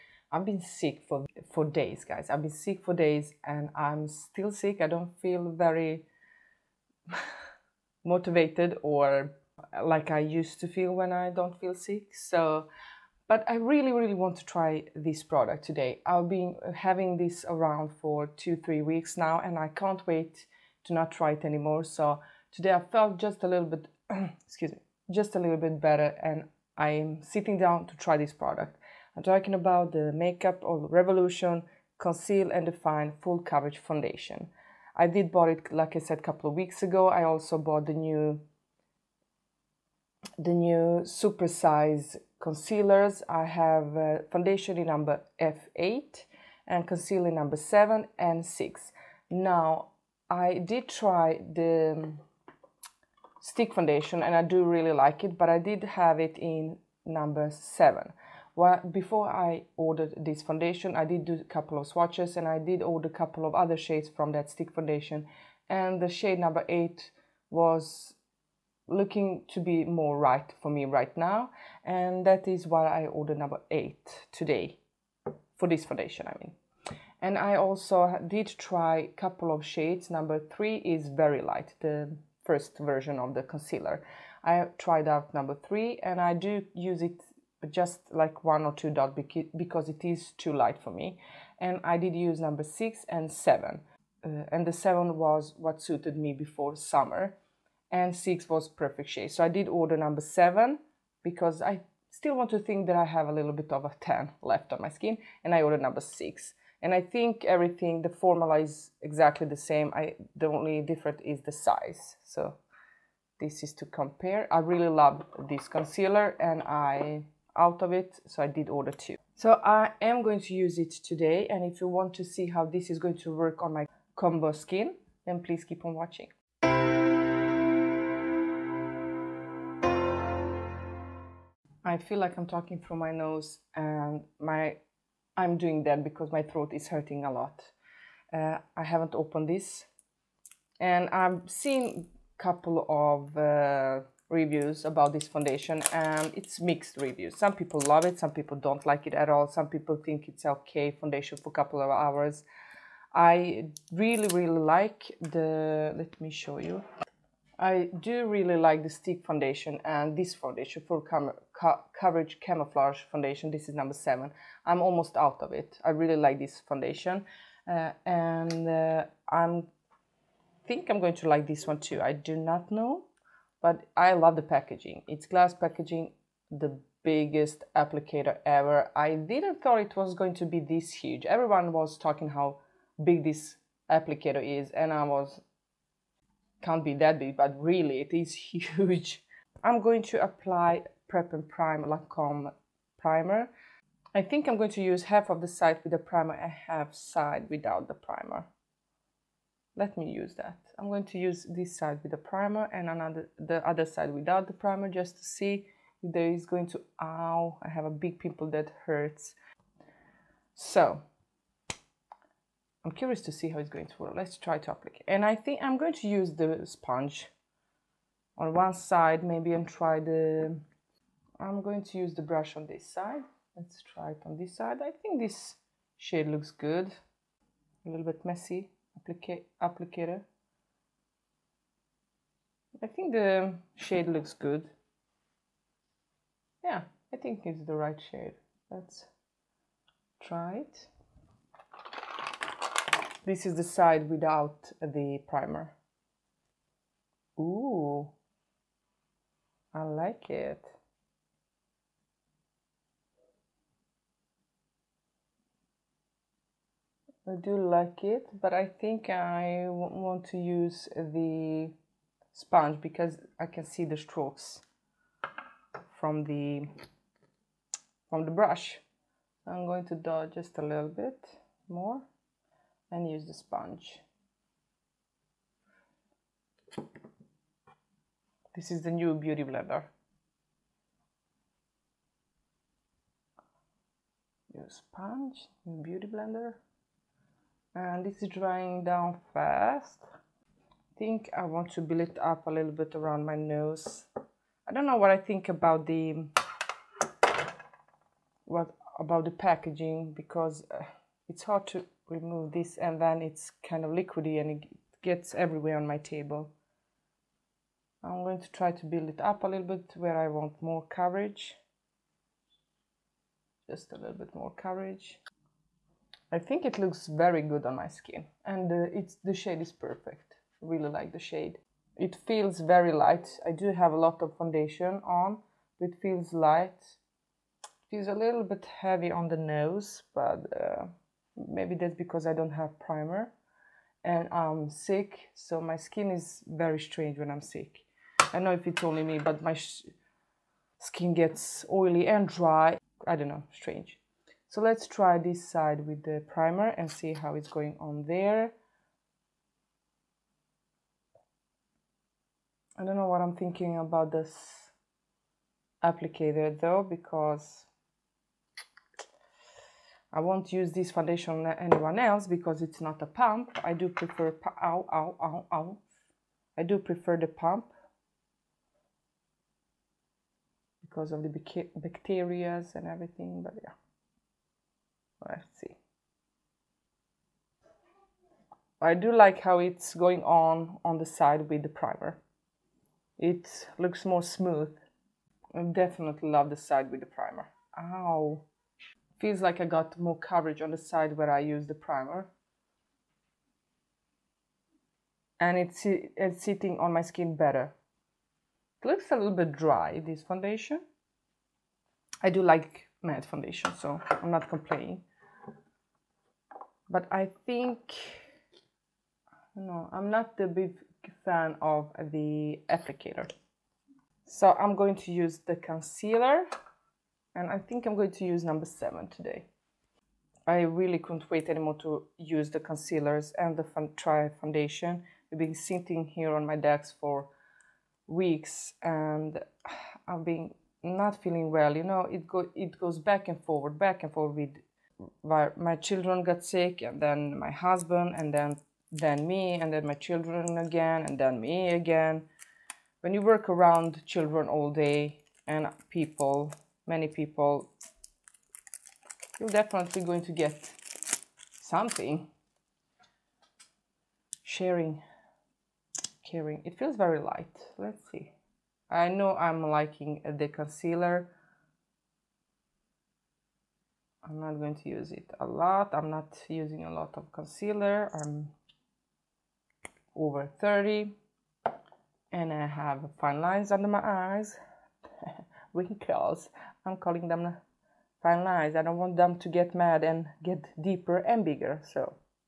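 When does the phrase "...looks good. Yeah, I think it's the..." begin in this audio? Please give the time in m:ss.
3:54.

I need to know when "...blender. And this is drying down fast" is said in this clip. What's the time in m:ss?
4:46.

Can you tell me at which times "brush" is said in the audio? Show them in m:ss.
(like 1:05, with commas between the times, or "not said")
3:42, 4:28.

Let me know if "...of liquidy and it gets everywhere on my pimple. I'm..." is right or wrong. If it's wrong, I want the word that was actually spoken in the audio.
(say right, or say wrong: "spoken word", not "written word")
wrong: "table", not "pimple".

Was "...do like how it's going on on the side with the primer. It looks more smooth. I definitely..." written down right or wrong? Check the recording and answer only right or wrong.
right.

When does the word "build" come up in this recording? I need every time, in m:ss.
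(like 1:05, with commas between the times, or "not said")
4:51, 5:08.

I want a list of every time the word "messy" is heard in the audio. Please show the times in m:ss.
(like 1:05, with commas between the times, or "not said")
3:48.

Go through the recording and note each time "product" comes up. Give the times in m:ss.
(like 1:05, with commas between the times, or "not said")
0:15, 0:28.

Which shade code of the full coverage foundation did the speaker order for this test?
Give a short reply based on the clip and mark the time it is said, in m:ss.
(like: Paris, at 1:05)
F8, at 0:45.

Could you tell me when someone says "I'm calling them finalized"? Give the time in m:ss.
7:56.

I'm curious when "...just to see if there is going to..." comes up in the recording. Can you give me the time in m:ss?
3:24.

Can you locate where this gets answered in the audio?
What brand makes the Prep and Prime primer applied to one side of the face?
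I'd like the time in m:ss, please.
3:11.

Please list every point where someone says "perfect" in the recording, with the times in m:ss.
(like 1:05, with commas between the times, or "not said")
1:38, 5:19.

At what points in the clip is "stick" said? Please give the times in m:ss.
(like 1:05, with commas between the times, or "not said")
0:53, 1:04, 2:38.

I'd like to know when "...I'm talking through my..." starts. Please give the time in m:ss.
2:12.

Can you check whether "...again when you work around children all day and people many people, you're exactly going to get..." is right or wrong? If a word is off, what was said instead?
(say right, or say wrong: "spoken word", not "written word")
wrong: "definitely", not "exactly".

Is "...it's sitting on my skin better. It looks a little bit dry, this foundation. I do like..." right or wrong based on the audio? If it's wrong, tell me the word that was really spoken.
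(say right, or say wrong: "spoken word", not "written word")
right.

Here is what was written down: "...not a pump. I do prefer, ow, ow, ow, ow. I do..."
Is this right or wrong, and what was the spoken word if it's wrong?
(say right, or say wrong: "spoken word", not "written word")
right.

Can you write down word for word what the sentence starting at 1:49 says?
I the only difference is the size.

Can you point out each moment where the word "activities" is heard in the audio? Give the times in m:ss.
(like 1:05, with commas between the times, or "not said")
not said.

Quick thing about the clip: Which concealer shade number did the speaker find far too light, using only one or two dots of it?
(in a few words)
3.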